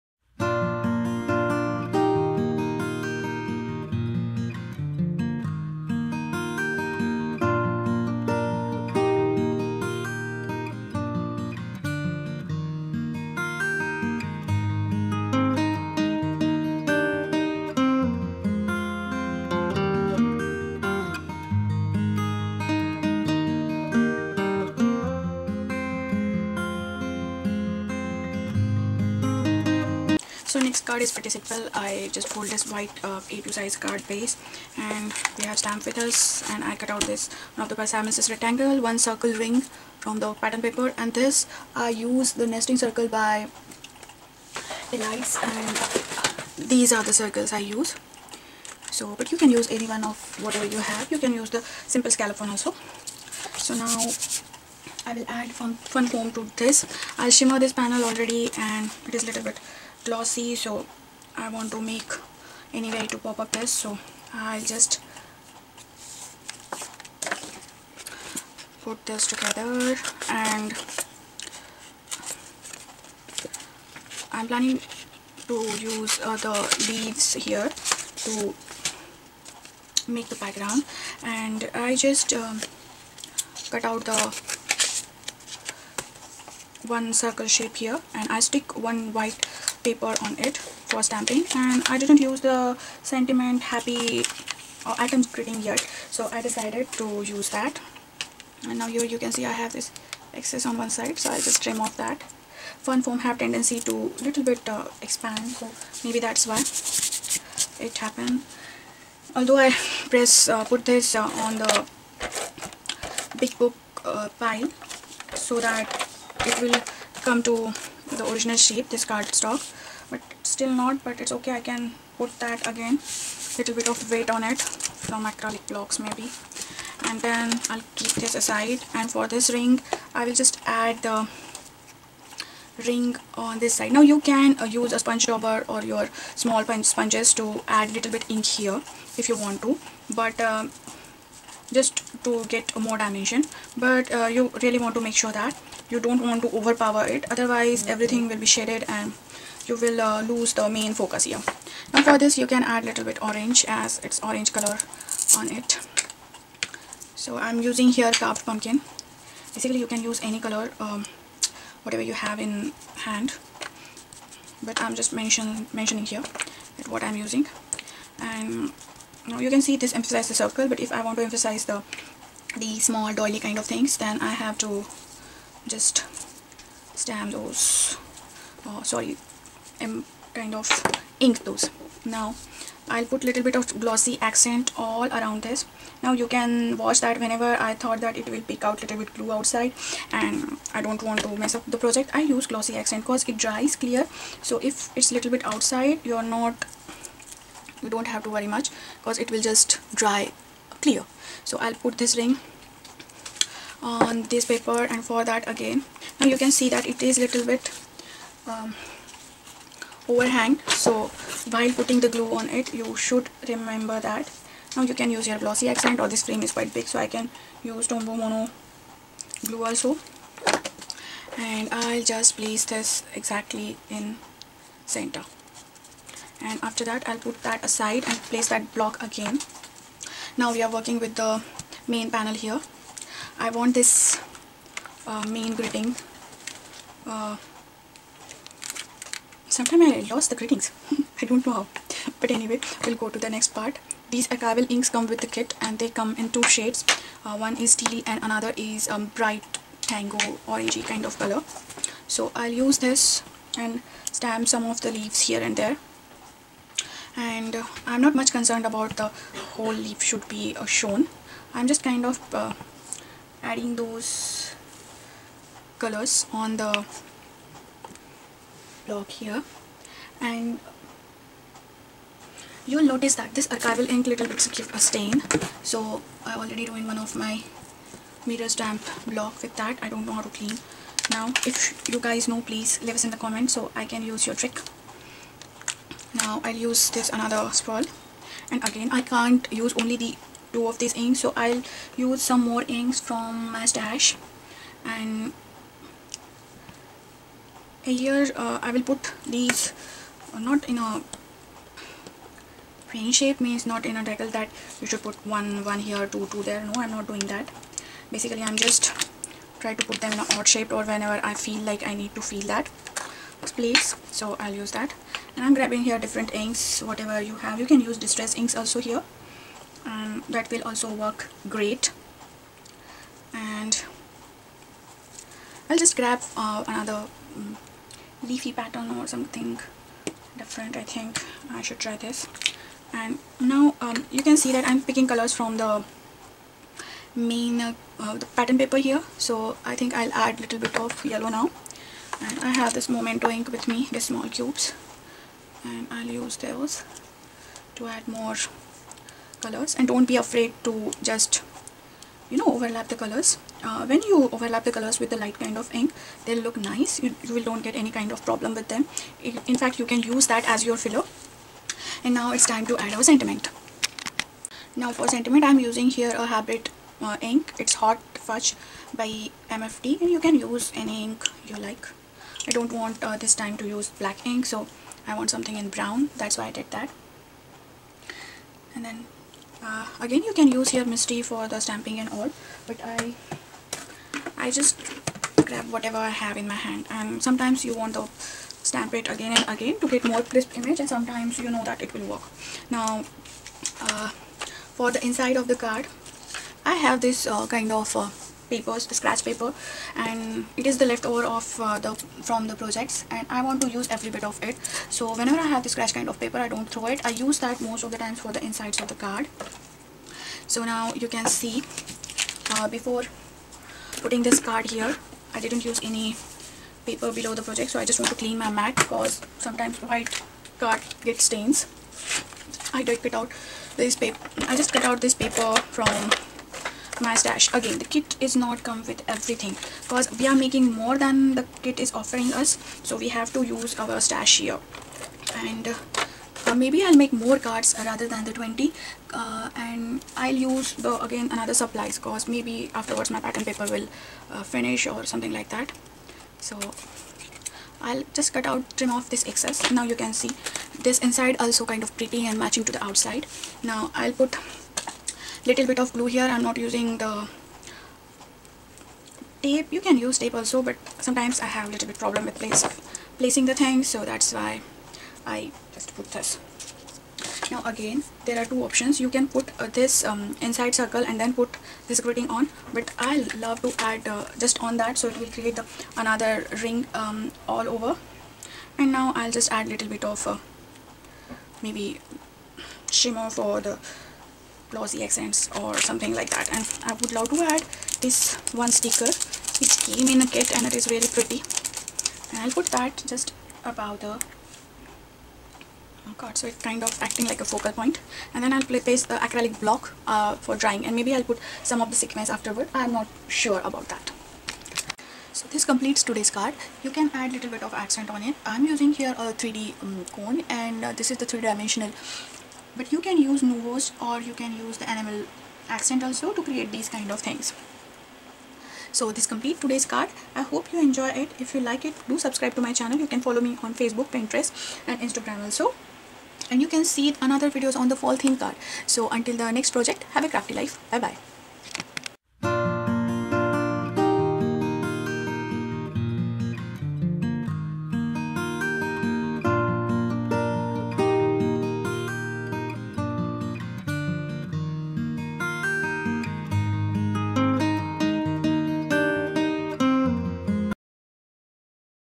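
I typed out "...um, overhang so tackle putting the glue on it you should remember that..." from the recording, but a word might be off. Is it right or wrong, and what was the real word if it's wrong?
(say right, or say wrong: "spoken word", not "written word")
wrong: "while", not "tackle".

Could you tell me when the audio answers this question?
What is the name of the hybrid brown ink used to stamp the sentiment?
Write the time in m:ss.
6:07.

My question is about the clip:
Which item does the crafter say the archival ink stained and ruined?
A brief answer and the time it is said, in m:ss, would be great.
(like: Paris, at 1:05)
mirror stamp block, at 4:38.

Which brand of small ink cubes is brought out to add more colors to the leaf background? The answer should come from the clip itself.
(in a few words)
Memento.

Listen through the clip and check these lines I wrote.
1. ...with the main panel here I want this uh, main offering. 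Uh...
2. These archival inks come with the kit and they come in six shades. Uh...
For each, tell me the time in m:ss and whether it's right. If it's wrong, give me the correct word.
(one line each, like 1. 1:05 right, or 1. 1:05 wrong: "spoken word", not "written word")
1. 3:50 wrong: "greeting", not "offering"
2. 4:04 wrong: "two", not "six".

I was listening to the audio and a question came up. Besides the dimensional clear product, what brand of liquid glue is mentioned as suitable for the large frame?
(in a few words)
Tombow Mono.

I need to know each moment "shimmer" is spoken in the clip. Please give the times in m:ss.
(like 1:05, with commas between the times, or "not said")
0:57, 8:02.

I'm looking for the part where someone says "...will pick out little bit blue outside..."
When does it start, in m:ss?
3:08.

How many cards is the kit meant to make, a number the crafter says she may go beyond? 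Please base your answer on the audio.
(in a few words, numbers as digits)
20.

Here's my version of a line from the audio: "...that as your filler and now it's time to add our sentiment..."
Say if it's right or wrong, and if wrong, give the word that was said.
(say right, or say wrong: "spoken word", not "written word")
right.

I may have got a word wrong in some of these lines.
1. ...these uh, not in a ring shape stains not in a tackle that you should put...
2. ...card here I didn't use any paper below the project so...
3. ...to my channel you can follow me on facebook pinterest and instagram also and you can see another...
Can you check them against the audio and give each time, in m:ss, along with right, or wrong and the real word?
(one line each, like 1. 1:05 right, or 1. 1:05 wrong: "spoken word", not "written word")
1. 4:59 wrong: "means", not "stains"
2. 6:54 right
3. 8:42 right.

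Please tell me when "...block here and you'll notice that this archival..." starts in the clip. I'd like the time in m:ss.
4:28.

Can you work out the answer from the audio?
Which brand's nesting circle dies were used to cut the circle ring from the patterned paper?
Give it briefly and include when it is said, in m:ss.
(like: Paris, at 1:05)
Elites, at 0:44.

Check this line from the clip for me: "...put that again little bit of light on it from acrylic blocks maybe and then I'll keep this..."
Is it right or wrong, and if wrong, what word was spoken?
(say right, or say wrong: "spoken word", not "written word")
wrong: "weight", not "light".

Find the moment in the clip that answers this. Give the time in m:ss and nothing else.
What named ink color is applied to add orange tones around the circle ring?
2:38.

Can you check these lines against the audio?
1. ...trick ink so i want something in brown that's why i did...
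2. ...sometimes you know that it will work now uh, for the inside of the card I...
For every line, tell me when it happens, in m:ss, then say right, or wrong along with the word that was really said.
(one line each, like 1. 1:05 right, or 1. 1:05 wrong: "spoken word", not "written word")
1. 6:14 wrong: "black", not "trick"
2. 6:30 right.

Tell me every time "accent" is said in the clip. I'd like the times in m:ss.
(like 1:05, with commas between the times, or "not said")
3:04, 3:12, 3:35, 8:05, 8:27, 8:35.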